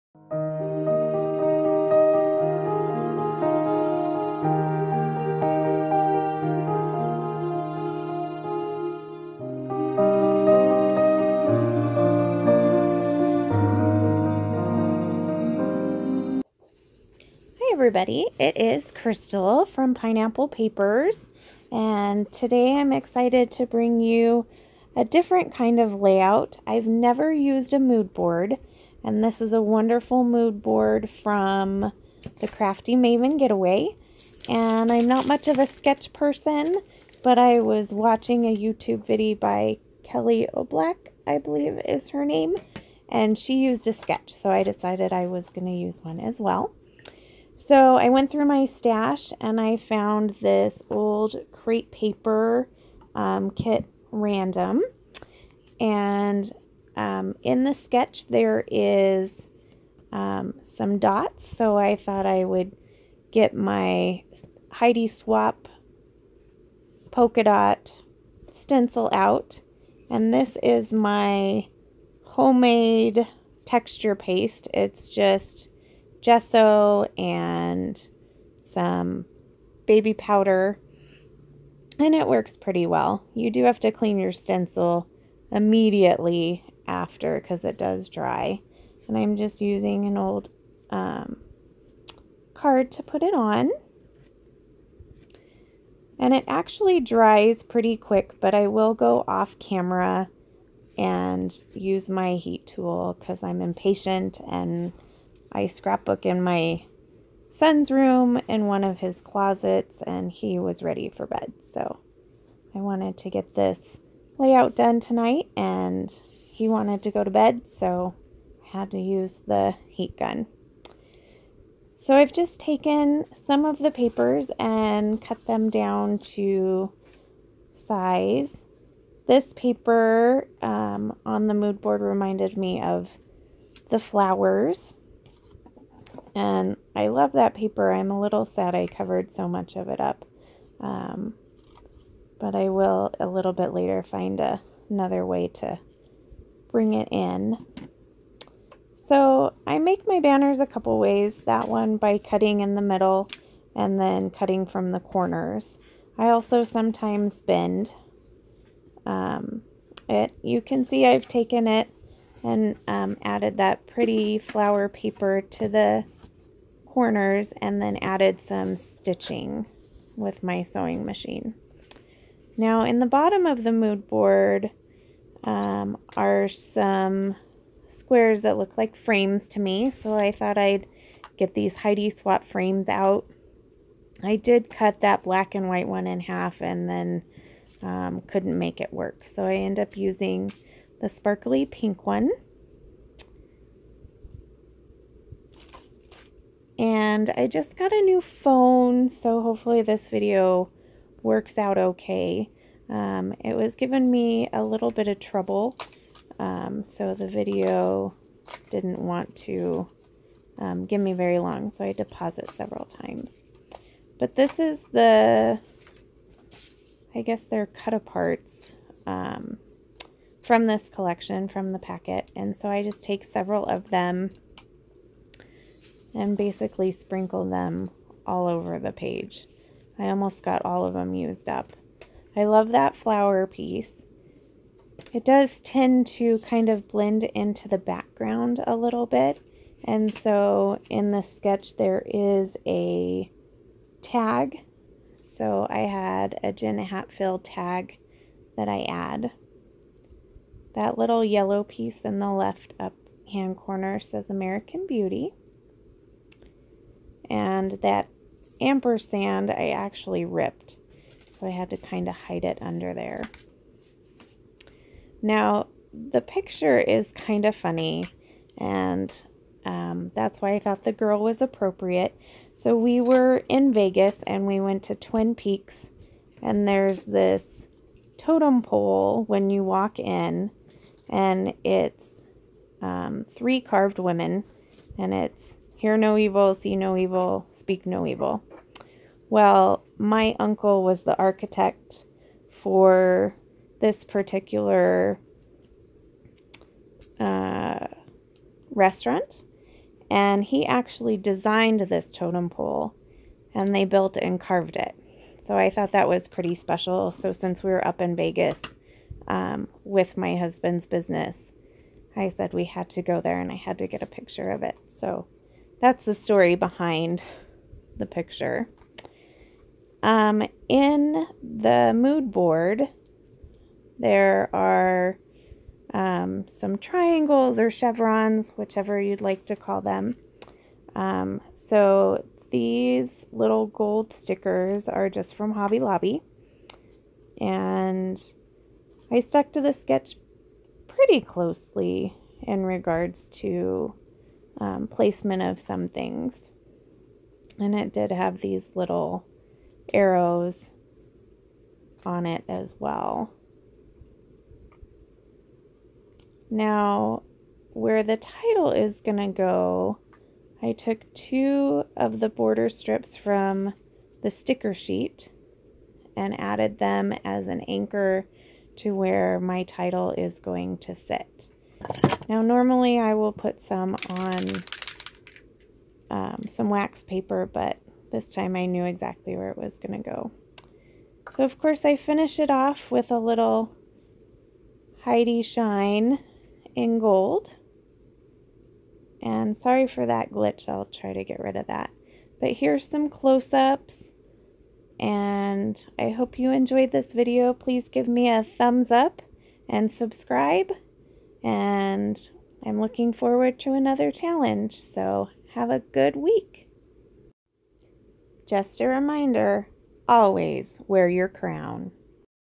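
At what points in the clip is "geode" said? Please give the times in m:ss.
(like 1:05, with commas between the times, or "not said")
not said.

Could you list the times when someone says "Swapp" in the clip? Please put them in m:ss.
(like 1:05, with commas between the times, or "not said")
1:05, 3:02.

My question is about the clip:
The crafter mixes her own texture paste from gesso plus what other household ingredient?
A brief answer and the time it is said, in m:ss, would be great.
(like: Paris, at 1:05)
baby powder, at 1:19.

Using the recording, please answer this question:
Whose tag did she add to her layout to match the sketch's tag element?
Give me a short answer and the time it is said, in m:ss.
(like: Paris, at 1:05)
Jen Hadfield, at 4:06.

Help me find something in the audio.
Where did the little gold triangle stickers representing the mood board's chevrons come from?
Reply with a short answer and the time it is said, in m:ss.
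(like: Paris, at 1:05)
Hobby Lobby, at 5:35.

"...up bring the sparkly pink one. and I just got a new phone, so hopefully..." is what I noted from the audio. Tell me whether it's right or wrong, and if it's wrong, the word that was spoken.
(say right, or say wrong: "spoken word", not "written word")
wrong: "using", not "bring".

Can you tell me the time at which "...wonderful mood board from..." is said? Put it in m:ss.
0:29.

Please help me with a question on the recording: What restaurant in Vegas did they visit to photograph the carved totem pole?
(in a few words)
Twin Peaks.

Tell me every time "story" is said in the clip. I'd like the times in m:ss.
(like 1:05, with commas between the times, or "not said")
5:16.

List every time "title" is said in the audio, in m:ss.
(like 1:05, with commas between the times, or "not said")
5:58, 6:09.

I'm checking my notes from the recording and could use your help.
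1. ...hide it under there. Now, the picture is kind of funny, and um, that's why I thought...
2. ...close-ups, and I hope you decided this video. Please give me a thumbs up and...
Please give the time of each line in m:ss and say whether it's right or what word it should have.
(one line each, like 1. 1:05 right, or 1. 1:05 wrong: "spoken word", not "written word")
1. 4:22 right
2. 6:33 wrong: "enjoyed", not "decided".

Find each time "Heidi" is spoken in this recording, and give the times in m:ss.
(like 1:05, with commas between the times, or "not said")
1:04, 3:01, 6:25.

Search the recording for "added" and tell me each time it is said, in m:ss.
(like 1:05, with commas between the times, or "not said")
2:43, 2:47, 6:06.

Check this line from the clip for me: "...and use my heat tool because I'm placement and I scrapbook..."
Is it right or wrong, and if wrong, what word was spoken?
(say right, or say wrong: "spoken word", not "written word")
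wrong: "impatient", not "placement".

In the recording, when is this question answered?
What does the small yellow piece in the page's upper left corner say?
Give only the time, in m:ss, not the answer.
4:14.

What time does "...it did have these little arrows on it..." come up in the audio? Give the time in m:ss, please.
5:47.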